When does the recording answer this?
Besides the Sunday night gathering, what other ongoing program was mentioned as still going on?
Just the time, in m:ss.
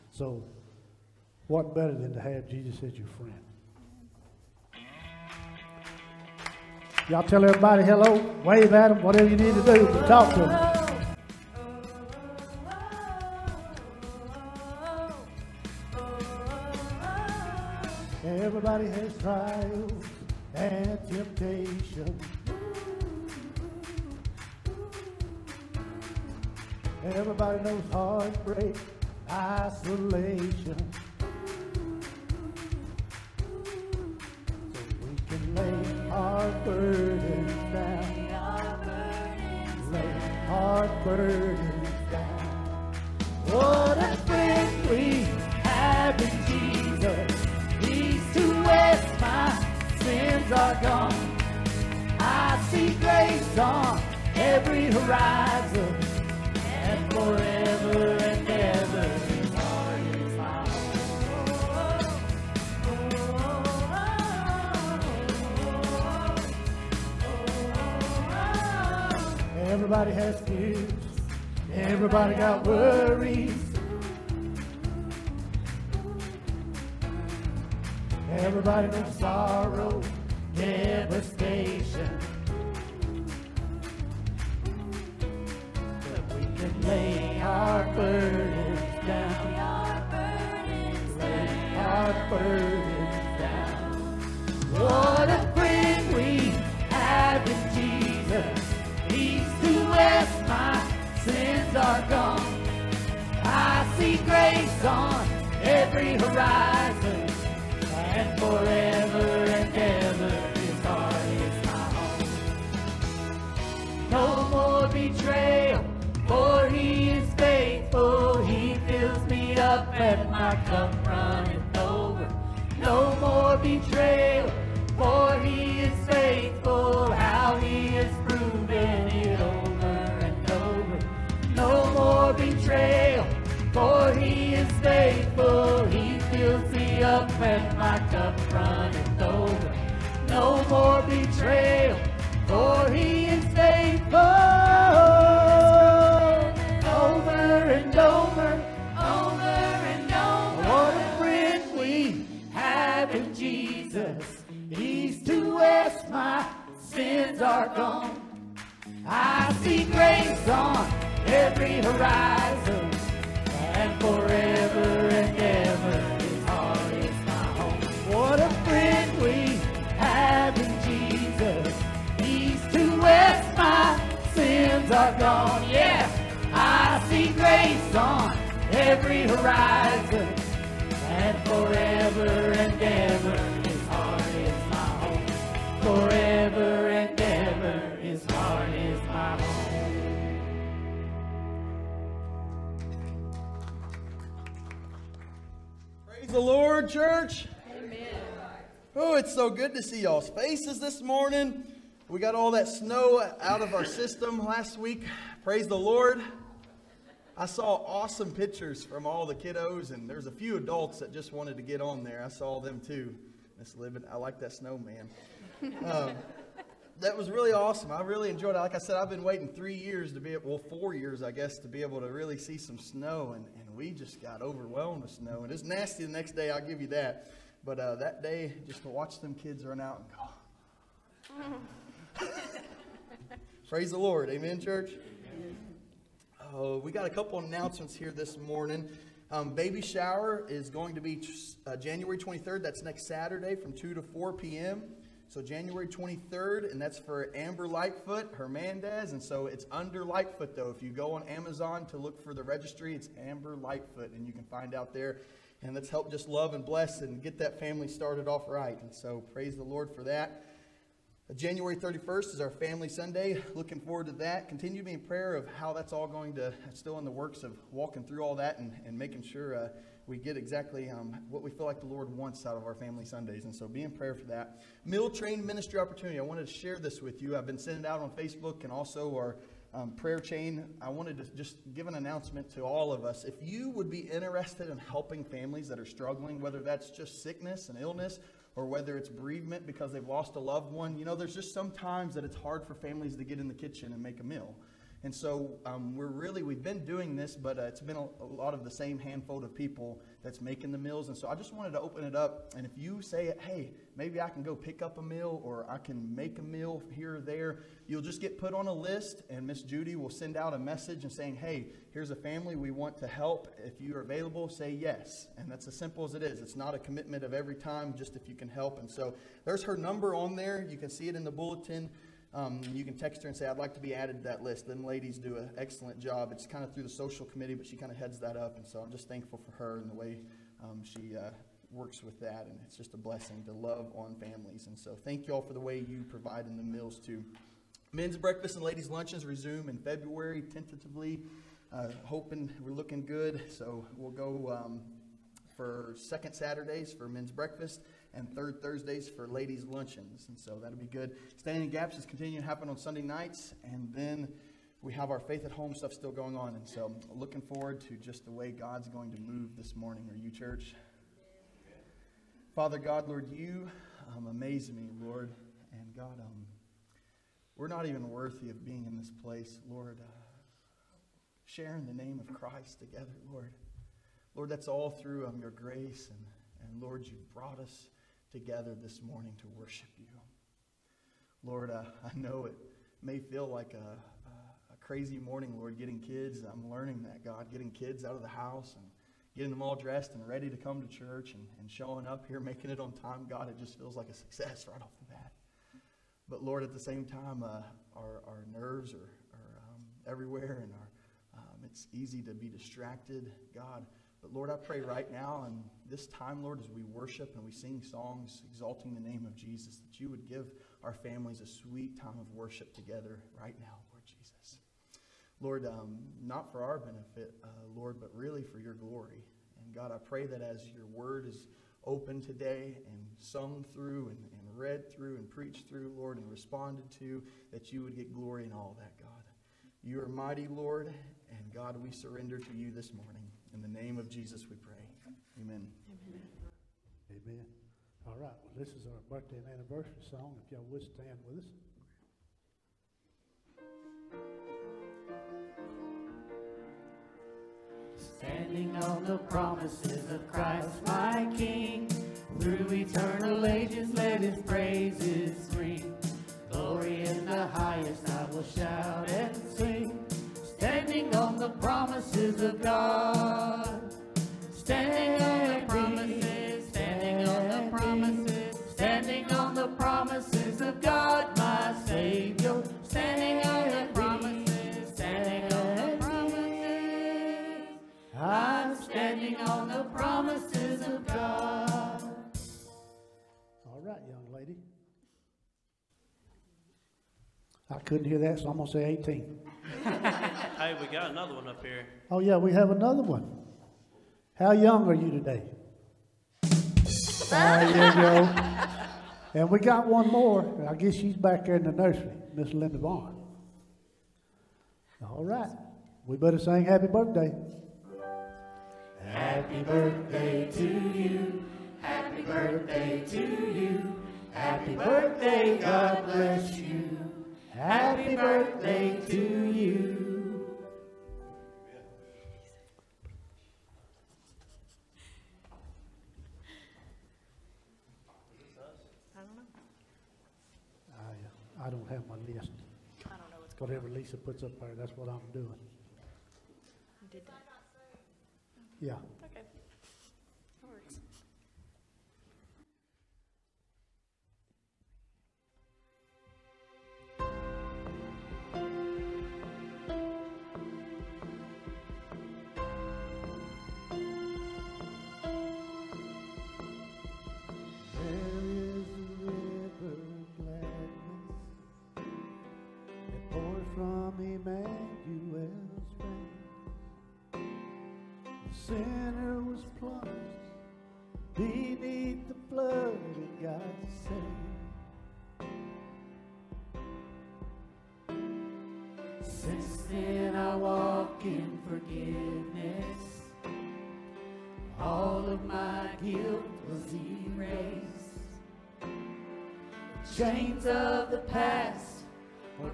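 5:55.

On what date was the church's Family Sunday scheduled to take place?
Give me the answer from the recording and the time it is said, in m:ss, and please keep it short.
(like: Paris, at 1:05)
January 31st, at 4:21.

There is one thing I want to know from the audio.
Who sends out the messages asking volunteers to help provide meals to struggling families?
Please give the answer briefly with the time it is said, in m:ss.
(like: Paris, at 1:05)
Miss Judy, at 5:09.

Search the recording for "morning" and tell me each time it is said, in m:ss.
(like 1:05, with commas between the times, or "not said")
3:21, 3:58, 5:59, 6:19, 6:25, 7:12.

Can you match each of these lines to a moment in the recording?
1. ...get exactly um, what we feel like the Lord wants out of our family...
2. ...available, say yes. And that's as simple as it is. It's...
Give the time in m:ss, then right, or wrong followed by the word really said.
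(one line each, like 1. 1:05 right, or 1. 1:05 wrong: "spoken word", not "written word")
1. 4:30 right
2. 5:14 right.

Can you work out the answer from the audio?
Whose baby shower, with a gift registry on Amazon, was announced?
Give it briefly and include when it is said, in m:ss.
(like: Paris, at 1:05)
Amber Lightfoot Hernandez, at 4:07.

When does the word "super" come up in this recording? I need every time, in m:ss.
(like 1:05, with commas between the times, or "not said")
not said.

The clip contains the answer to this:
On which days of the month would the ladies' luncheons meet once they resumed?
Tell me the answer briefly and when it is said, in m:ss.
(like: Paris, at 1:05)
Third Thursdays, at 5:48.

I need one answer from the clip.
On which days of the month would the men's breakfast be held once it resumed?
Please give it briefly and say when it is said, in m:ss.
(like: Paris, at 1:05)
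Second Saturdays, at 5:45.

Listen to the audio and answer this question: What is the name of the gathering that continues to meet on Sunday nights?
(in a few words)
Standing in Gaps.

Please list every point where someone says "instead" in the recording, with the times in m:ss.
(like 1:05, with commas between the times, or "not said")
not said.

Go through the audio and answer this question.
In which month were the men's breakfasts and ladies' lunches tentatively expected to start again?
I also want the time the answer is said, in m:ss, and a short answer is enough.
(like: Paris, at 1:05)
February, at 5:39.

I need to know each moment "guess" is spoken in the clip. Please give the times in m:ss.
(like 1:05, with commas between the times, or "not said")
3:41, 8:20.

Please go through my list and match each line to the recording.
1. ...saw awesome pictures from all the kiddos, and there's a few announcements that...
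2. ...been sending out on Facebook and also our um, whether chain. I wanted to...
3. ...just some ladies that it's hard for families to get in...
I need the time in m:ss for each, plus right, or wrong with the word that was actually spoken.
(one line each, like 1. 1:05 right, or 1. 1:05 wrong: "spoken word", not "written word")
1. 3:27 wrong: "adults", not "announcements"
2. 4:37 wrong: "prayer", not "whether"
3. 4:51 wrong: "times", not "ladies".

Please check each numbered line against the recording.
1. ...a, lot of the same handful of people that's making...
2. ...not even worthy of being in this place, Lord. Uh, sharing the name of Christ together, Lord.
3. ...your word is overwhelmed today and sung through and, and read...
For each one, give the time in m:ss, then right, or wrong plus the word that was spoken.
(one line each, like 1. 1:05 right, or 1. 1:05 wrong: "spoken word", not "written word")
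1. 4:58 right
2. 6:07 right
3. 7:00 wrong: "opened", not "overwhelmed".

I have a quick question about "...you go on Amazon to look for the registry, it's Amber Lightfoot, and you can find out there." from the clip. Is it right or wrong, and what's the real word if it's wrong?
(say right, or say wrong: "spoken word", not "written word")
right.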